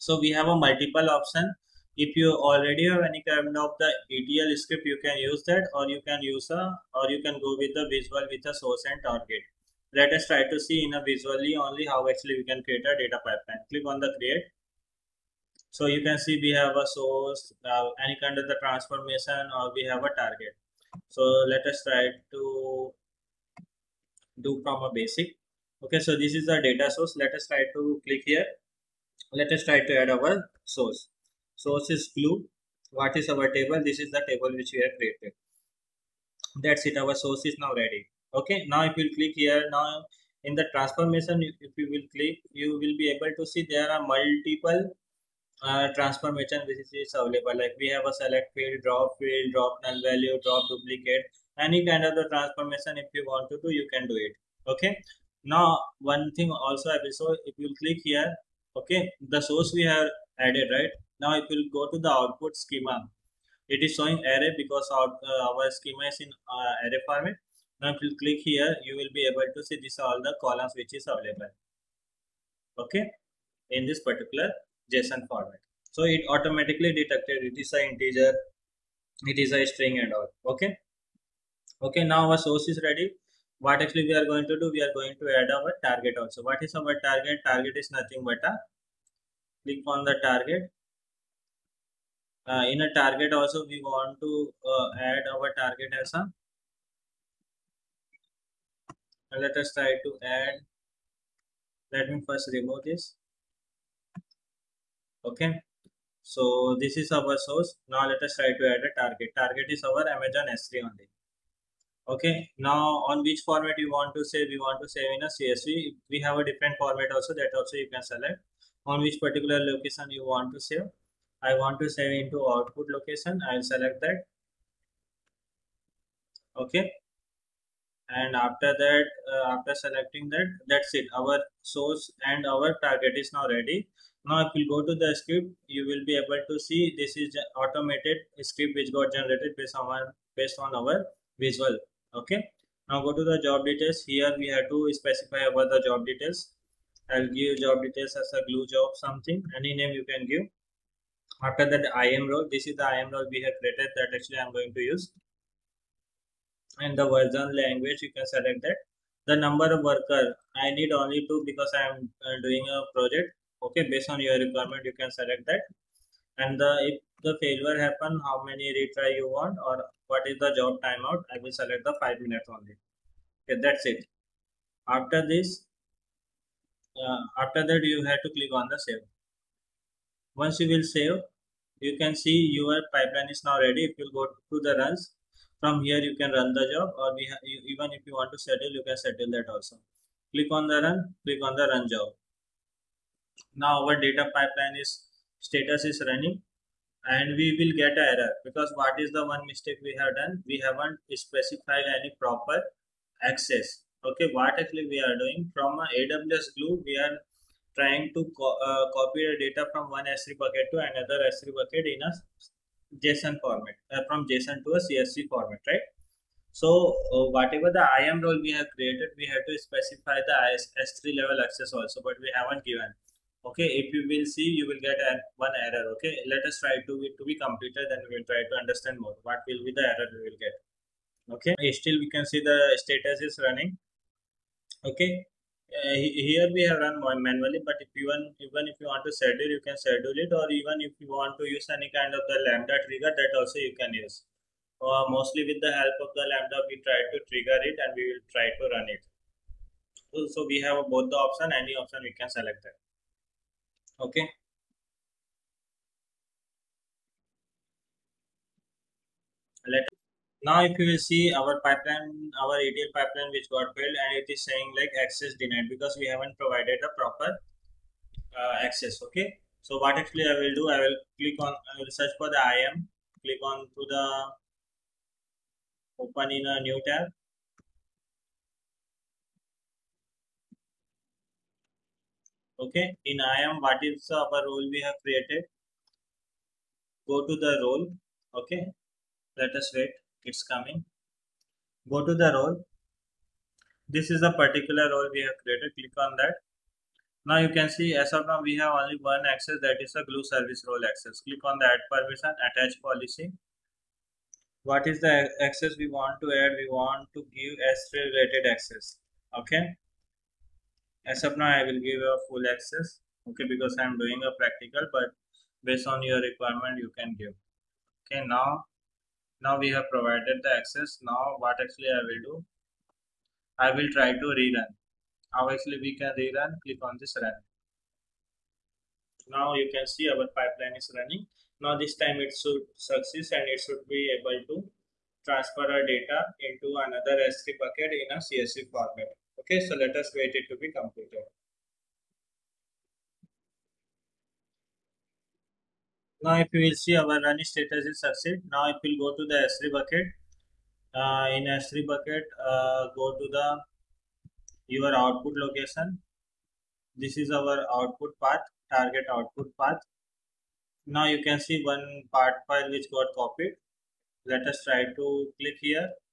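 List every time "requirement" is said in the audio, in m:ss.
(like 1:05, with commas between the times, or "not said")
2:44, 5:16.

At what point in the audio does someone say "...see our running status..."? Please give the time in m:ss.
5:46.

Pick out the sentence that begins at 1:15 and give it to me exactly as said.
So it automatically detected it is an integer, it is a string and all.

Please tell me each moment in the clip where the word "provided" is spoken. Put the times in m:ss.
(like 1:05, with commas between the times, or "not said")
4:26, 5:19.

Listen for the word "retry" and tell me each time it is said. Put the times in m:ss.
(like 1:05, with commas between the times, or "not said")
2:48.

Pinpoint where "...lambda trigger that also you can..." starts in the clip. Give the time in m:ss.
4:02.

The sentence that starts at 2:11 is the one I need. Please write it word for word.
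Our source and our target is now ready.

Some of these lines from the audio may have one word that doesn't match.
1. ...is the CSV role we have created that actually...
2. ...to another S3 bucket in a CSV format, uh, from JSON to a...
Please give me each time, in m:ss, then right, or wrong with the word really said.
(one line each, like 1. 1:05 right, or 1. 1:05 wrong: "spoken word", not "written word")
1. 2:32 wrong: "IAM", not "CSV"
2. 3:30 wrong: "JSON", not "CSV".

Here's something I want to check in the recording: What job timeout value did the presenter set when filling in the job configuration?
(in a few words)
5 minutes.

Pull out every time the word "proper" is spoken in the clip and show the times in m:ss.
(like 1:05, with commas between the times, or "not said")
3:22, 4:26.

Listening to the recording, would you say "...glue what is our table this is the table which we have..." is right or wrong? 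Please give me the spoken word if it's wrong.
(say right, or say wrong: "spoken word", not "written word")
right.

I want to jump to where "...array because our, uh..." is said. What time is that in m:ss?
1:04.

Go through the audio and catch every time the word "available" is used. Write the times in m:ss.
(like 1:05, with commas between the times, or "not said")
0:47, 1:11.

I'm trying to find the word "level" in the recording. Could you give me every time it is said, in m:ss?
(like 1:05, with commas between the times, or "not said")
3:41.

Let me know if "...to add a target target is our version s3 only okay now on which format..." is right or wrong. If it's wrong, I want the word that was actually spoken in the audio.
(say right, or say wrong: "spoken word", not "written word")
wrong: "amazon", not "version".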